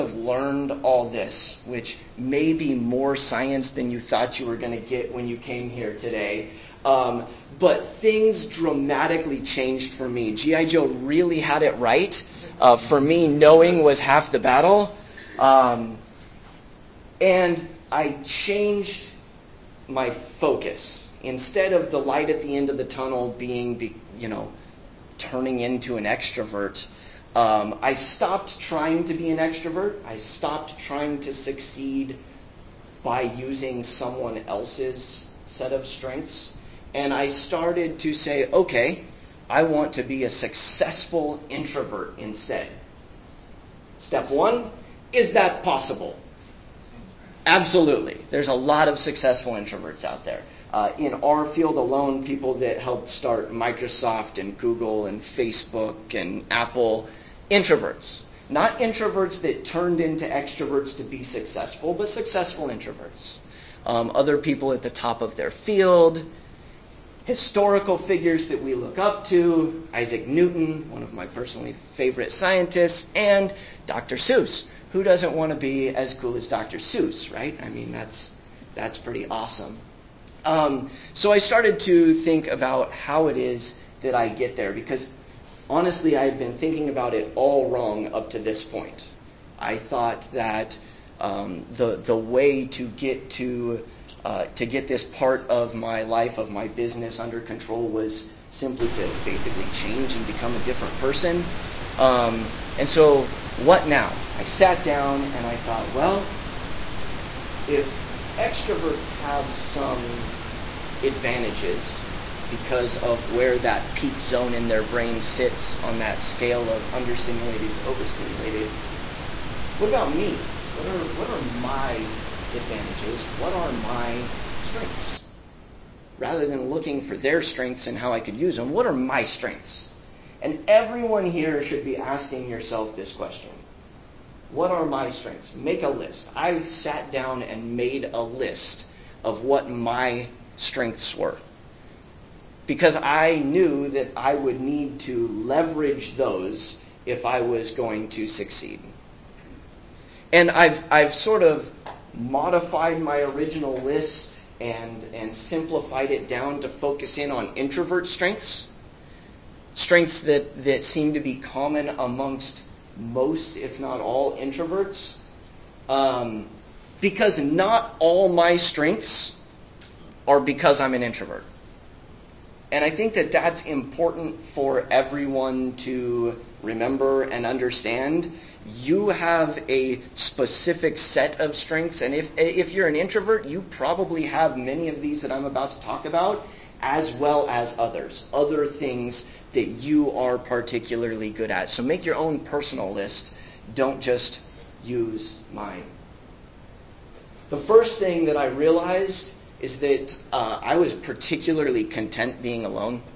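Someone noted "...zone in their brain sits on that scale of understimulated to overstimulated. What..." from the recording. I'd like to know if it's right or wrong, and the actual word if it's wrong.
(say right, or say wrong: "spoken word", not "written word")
right.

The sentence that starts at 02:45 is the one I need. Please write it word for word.
Um, because not all my strengths are because I'm an introvert.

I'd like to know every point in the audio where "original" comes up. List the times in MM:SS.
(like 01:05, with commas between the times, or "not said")
02:33.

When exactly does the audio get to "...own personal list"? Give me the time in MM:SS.
03:12.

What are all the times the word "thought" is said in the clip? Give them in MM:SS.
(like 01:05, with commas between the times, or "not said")
00:04, 01:29, 01:45.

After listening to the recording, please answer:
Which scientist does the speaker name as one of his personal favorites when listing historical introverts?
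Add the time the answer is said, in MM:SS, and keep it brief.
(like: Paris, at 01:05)
Isaac Newton, at 01:09.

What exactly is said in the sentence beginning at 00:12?
Uh, for me, knowing was half the battle.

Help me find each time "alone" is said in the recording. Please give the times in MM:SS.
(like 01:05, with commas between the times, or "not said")
00:51, 03:22.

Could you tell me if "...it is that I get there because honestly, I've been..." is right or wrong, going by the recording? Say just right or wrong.
right.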